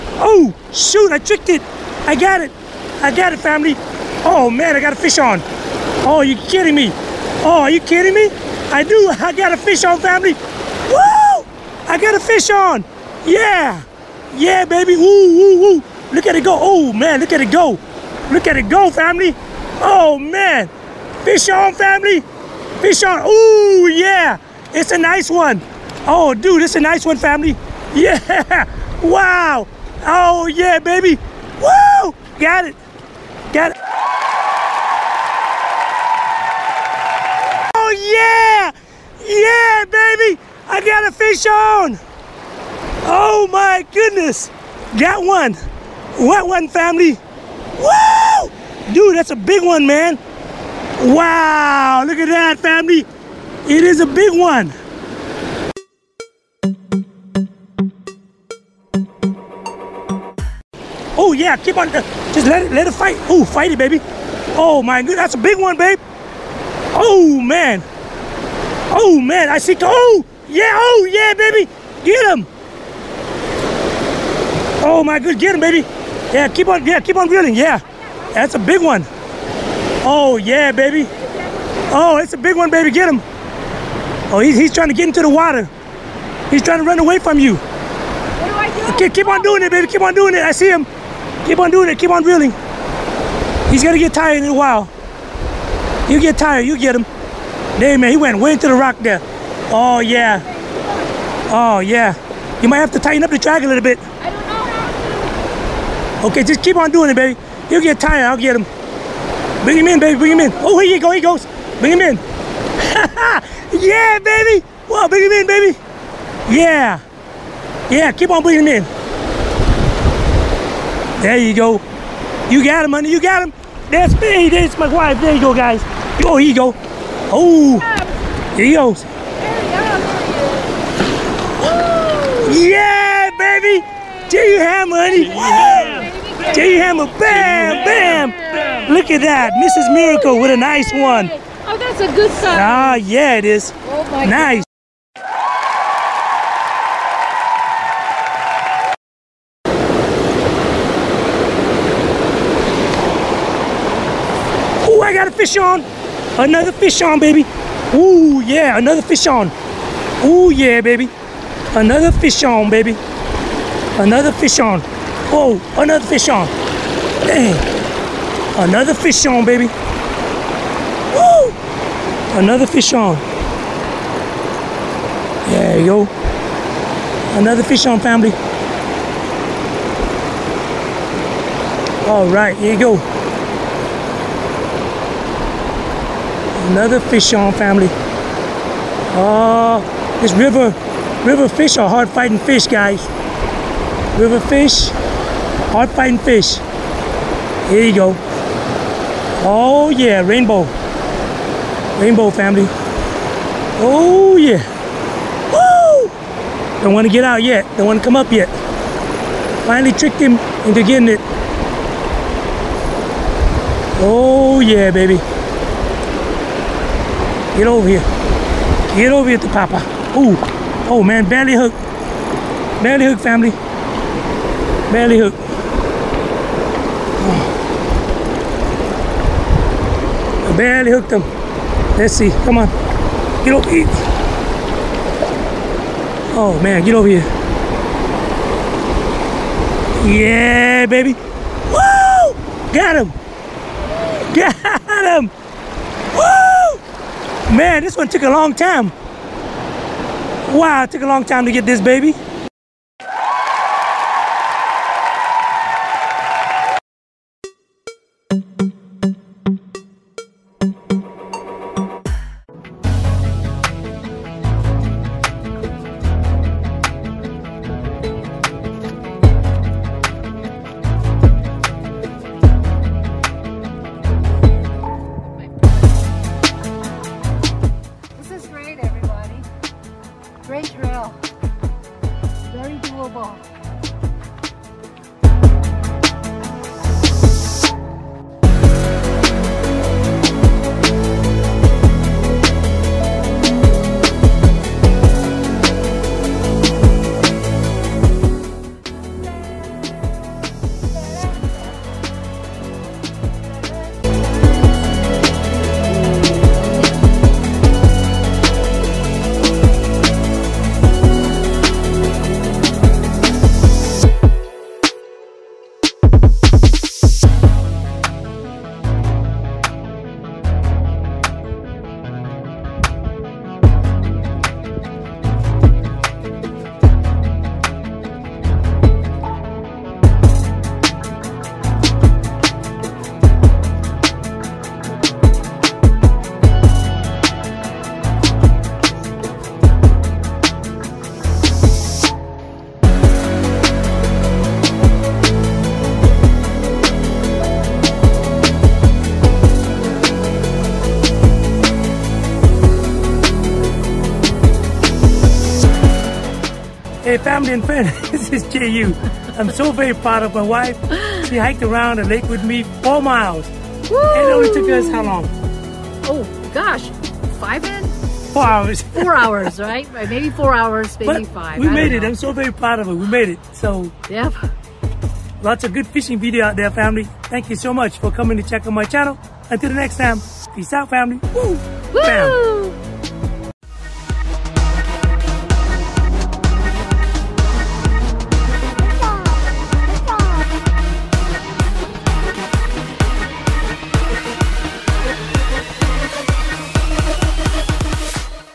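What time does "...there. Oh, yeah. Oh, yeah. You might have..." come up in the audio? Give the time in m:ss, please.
1:38.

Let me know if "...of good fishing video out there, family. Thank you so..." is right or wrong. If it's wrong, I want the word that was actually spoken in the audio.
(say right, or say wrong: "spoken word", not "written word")
right.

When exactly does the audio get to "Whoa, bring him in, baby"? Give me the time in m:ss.
1:54.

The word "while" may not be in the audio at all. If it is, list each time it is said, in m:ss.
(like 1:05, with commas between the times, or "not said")
1:34.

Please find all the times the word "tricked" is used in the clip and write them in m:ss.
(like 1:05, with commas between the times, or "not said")
0:01, 3:29.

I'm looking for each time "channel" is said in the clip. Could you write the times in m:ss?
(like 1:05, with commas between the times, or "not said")
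6:18.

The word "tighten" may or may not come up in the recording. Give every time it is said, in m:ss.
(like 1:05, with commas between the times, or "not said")
1:42.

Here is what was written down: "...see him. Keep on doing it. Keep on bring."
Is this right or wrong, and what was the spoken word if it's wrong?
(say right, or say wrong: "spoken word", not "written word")
wrong: "reeling", not "bring".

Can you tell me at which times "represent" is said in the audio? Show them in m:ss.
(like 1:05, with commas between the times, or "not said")
not said.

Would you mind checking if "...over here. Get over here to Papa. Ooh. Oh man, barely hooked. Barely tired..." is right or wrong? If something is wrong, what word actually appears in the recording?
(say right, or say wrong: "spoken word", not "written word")
wrong: "hooked", not "tired".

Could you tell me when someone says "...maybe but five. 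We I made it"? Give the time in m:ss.
6:10.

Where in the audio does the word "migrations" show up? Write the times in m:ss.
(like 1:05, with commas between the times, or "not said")
not said.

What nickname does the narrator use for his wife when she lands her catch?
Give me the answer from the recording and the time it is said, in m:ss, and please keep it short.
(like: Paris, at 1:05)
Mrs. Miracle, at 2:19.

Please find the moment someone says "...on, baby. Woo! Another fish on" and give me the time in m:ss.
2:49.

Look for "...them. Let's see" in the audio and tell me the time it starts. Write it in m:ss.
3:51.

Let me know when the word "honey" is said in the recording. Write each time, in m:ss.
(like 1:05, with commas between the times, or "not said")
2:02, 2:14.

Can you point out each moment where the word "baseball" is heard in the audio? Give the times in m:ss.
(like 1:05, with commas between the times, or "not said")
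not said.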